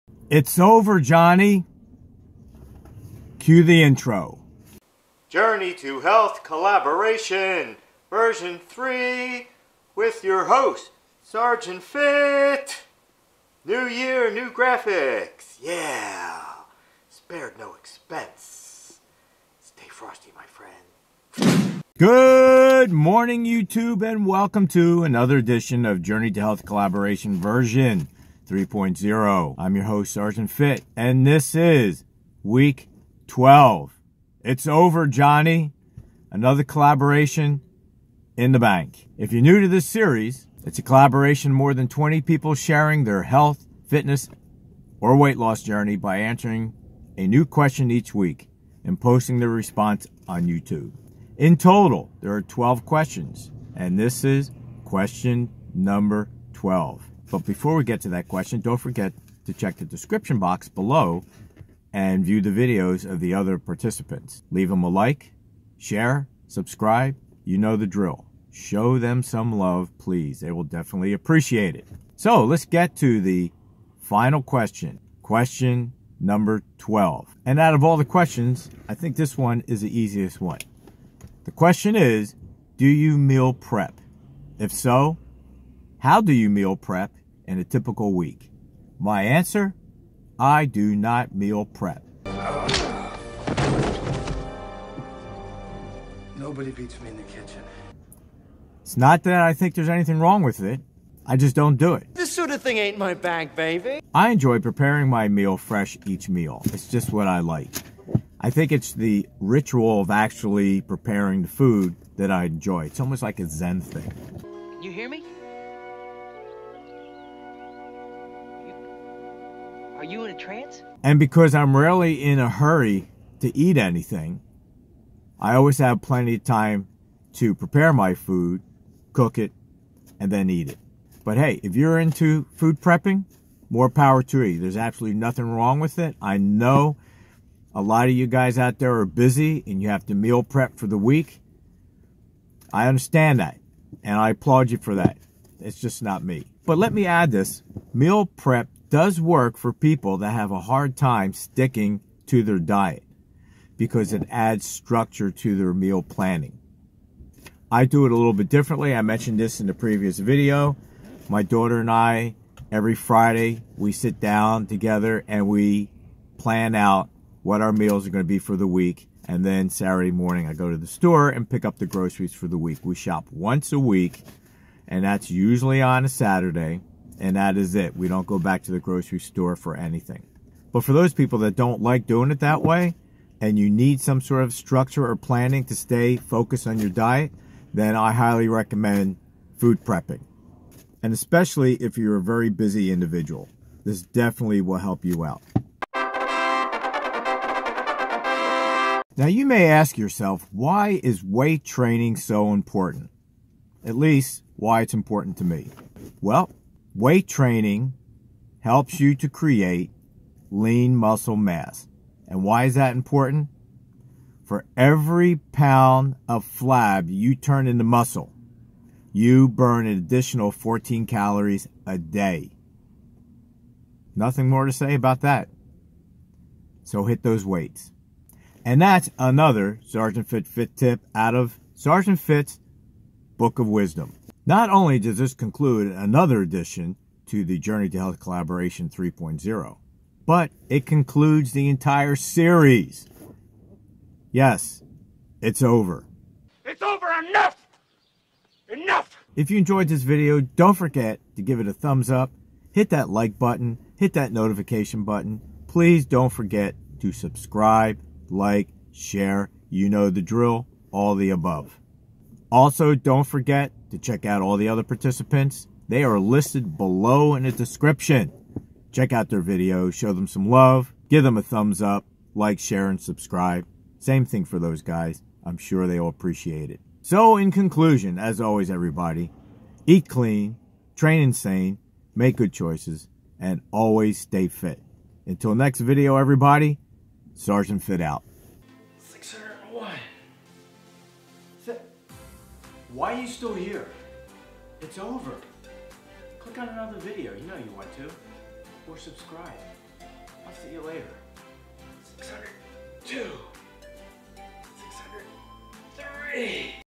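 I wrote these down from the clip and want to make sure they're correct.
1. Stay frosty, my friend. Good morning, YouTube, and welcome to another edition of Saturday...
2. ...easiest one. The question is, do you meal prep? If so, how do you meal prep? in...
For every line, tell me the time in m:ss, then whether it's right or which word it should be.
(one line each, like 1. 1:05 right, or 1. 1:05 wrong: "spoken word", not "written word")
1. 0:19 wrong: "Journey", not "Saturday"
2. 1:19 right.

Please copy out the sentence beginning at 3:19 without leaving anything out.
Now you may ask yourself, why is weight training so important?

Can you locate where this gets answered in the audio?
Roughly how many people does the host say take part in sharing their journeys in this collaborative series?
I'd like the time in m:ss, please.
0:41.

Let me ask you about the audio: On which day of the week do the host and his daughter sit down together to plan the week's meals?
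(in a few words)
Friday.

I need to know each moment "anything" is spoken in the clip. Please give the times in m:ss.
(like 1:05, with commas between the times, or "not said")
1:39, 2:03, 2:59.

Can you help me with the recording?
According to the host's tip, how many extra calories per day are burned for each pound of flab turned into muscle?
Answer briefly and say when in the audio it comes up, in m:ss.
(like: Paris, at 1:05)
14, at 3:40.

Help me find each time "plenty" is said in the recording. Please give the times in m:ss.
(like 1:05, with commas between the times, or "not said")
2:06.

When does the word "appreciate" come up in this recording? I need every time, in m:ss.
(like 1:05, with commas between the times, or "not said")
1:11, 4:36.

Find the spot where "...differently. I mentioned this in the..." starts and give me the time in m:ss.
2:38.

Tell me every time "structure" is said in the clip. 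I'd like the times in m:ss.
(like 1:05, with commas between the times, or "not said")
2:34, 3:04.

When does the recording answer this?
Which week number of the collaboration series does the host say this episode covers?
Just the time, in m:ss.
0:32.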